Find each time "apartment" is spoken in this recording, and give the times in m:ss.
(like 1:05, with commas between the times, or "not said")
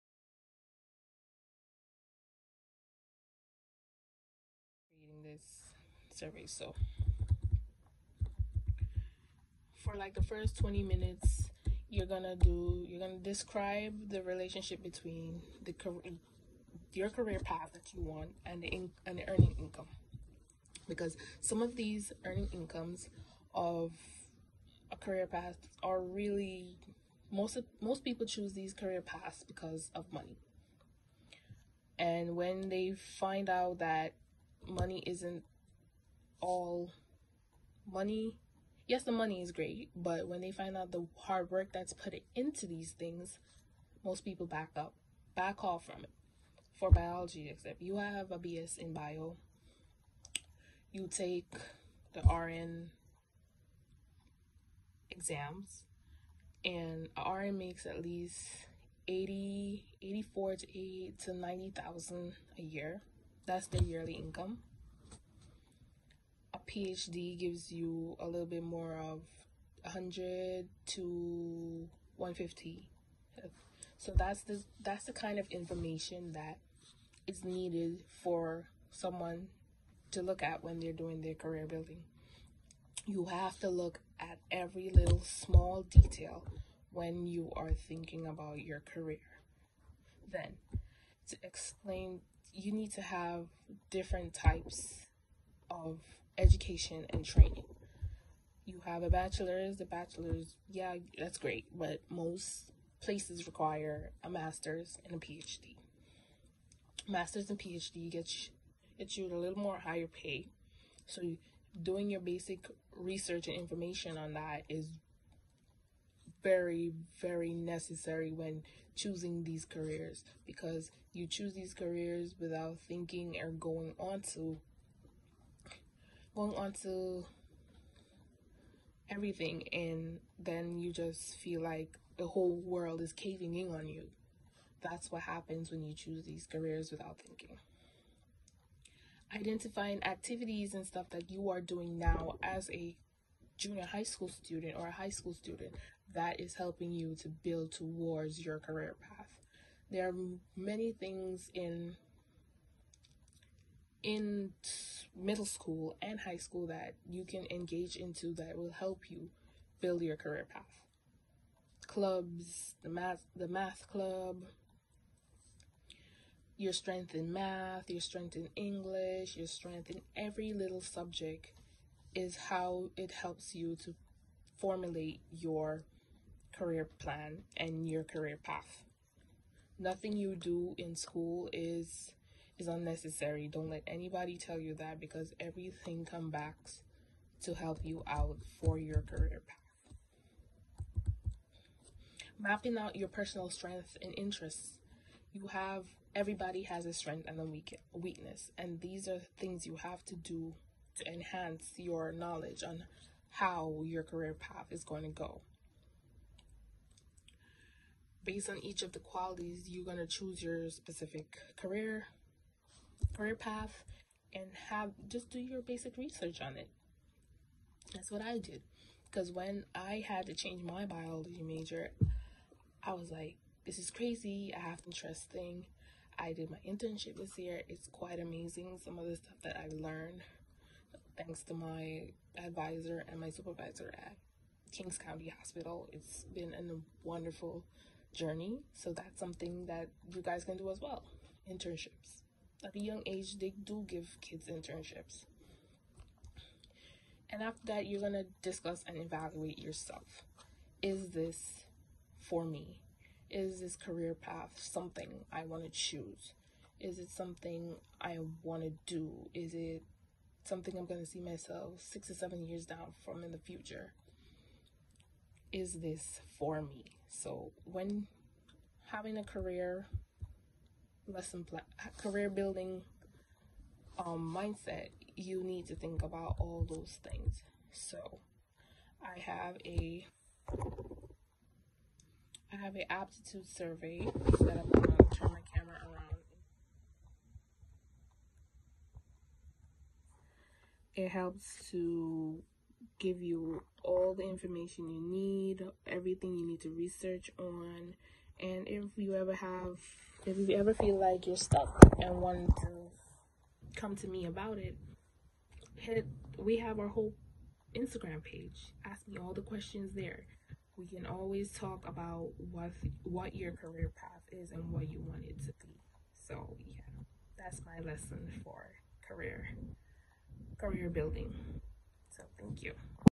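not said.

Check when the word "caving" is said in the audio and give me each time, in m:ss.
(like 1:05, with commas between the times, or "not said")
2:13.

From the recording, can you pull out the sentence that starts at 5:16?
So yeah, that's my lesson for career career building.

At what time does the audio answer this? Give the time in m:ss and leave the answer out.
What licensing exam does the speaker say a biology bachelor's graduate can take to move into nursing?
0:52.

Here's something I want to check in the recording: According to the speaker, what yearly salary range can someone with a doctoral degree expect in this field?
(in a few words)
100 to 150.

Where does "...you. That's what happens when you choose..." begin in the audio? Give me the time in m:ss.
2:13.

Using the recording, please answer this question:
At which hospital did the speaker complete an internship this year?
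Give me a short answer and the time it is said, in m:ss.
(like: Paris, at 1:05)
Kings County Hospital, at 3:54.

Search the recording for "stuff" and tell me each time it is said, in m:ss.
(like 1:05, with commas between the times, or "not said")
2:20, 3:49.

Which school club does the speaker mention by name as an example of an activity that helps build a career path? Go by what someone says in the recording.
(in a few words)
math club.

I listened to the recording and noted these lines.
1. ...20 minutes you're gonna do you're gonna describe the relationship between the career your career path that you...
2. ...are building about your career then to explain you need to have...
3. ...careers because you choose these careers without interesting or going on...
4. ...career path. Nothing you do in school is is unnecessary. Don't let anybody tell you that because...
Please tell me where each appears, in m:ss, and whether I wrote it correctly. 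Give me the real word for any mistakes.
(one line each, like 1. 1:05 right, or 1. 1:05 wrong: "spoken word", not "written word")
1. 0:10 right
2. 1:27 wrong: "thinking", not "building"
3. 1:59 wrong: "thinking", not "interesting"
4. 2:58 right.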